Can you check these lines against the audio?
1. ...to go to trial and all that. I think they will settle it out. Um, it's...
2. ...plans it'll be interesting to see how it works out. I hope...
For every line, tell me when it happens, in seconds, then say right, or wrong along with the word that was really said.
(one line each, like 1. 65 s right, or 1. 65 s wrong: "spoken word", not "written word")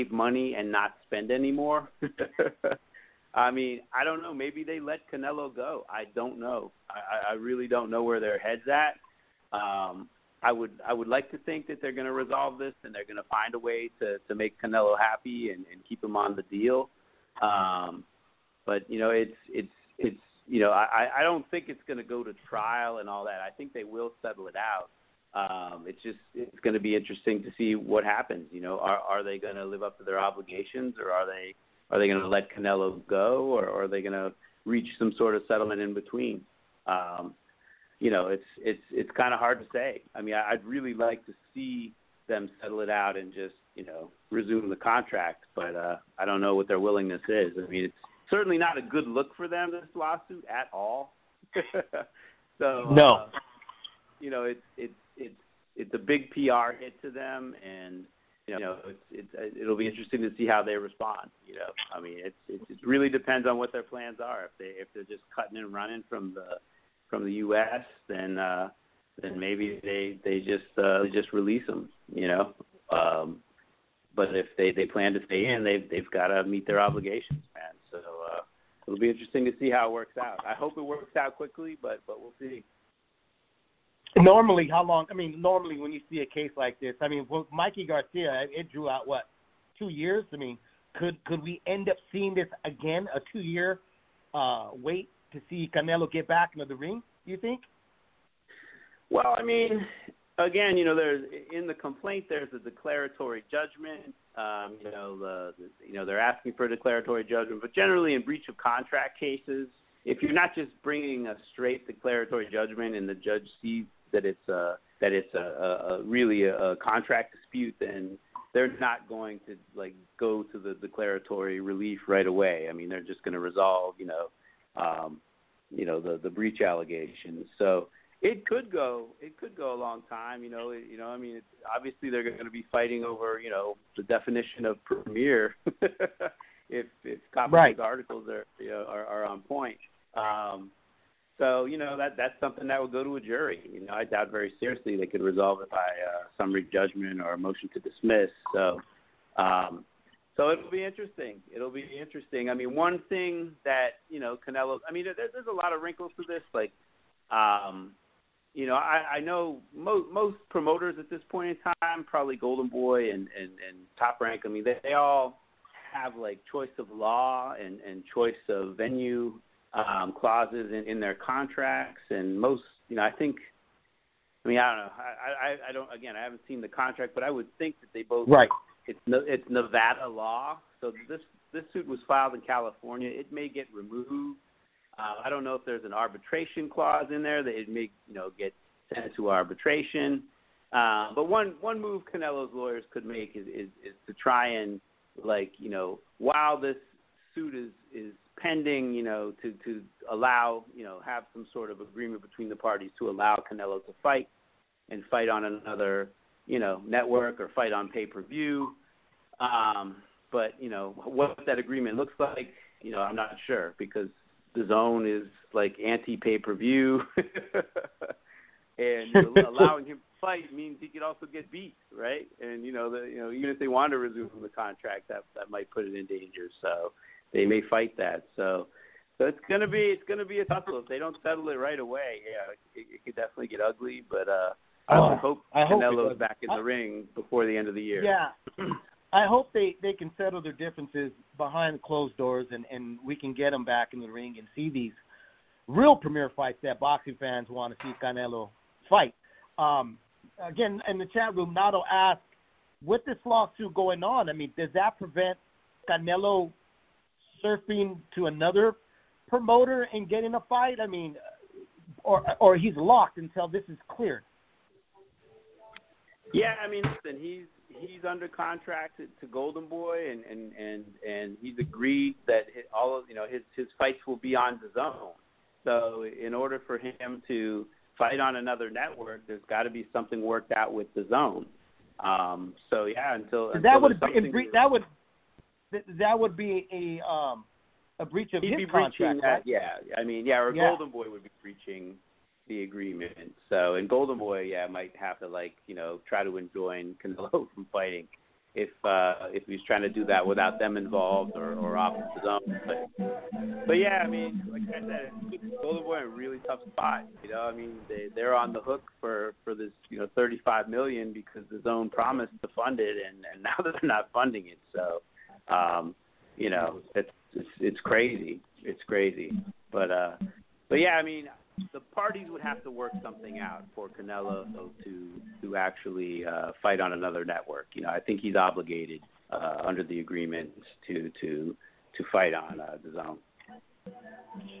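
1. 21 s right
2. 76 s wrong: "obligations", not "plans".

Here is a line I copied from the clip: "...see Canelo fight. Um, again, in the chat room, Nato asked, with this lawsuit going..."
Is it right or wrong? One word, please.
right.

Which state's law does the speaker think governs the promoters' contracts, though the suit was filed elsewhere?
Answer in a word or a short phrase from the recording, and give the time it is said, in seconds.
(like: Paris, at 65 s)
Nevada, at 179 s.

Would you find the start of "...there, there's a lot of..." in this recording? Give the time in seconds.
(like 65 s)
155 s.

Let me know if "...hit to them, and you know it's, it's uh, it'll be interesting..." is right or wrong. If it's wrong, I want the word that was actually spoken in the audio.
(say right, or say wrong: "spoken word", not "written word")
right.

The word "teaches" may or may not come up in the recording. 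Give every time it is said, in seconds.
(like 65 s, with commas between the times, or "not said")
not said.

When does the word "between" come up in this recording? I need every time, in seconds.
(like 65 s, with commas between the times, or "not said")
35 s, 202 s.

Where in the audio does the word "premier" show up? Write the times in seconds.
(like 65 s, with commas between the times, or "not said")
134 s, 245 s.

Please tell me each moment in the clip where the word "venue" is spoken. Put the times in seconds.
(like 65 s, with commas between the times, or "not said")
168 s.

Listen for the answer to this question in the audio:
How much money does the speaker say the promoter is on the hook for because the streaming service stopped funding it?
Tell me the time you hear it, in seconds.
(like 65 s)
310 s.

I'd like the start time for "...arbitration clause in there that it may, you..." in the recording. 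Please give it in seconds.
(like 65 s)
185 s.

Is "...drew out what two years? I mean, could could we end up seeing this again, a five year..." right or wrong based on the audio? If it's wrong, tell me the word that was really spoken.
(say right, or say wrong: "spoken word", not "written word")
wrong: "two", not "five".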